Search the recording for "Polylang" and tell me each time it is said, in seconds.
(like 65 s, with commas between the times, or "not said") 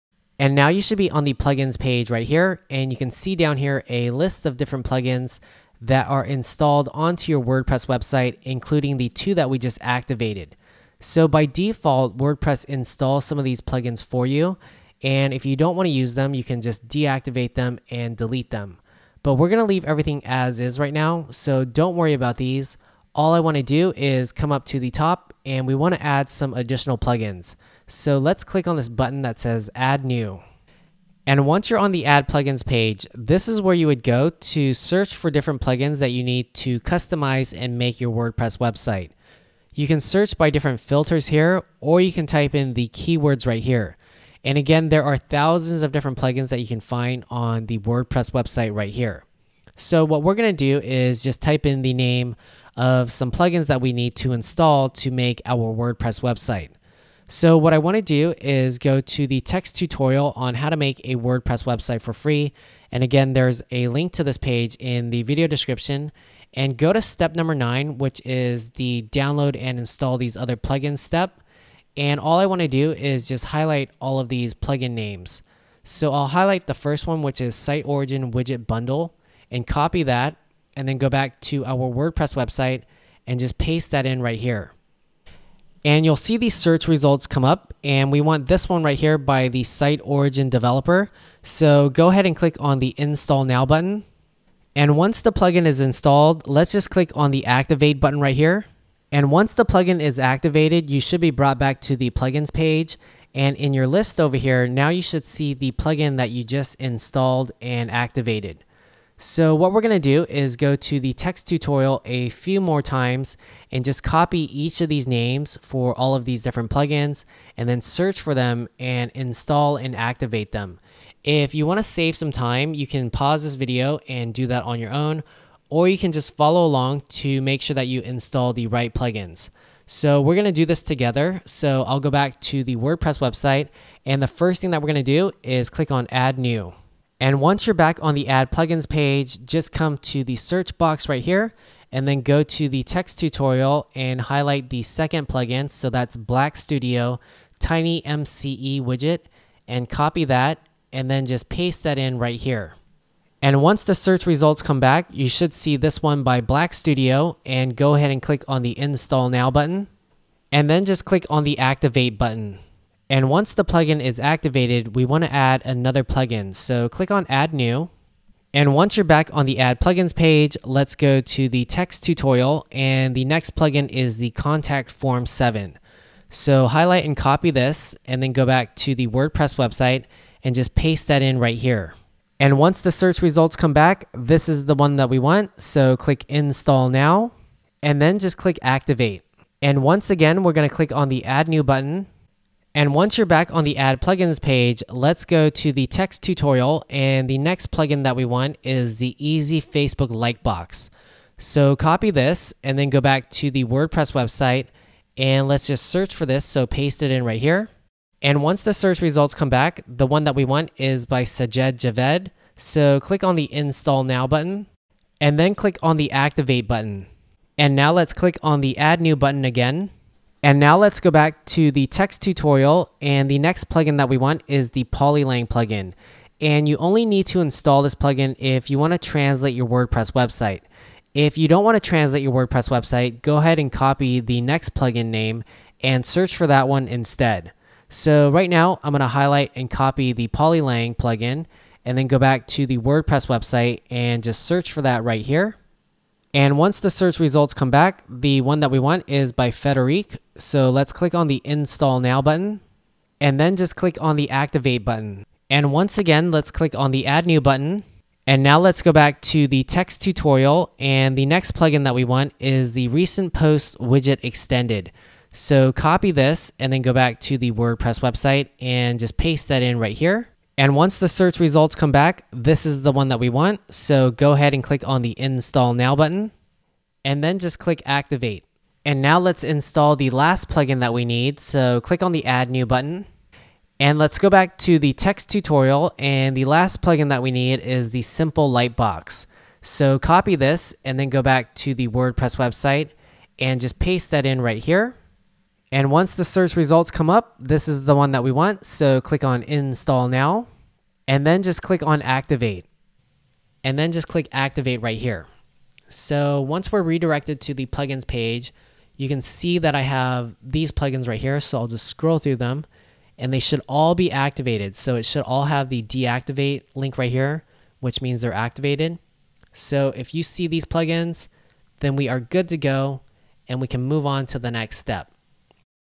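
224 s, 240 s.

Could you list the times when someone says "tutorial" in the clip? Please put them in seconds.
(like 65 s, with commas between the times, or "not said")
59 s, 111 s, 143 s, 172 s, 196 s, 222 s, 260 s, 285 s.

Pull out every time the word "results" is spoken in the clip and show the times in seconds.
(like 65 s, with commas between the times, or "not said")
86 s, 154 s, 183 s, 209 s, 247 s, 271 s, 296 s.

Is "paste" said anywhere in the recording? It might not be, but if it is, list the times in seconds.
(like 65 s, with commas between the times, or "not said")
83 s, 151 s, 180 s, 206 s, 269 s, 293 s.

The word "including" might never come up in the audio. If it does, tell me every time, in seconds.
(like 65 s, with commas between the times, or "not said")
8 s.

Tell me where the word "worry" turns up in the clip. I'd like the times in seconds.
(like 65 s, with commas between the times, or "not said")
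21 s.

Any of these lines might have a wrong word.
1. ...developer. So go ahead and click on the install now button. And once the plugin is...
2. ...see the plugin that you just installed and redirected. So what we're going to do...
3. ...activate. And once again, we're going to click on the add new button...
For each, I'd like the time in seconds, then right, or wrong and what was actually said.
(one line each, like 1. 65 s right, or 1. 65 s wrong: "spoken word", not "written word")
1. 90 s right
2. 105 s wrong: "activated", not "redirected"
3. 188 s right.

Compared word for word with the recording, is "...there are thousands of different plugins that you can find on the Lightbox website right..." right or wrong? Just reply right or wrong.
wrong.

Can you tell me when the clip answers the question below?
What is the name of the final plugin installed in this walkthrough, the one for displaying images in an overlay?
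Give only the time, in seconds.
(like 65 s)
288 s.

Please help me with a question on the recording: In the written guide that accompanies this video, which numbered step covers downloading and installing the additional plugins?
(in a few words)
9.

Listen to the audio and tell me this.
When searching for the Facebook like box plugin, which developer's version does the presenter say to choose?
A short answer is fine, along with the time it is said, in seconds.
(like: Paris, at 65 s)
Sajid Javed, at 211 s.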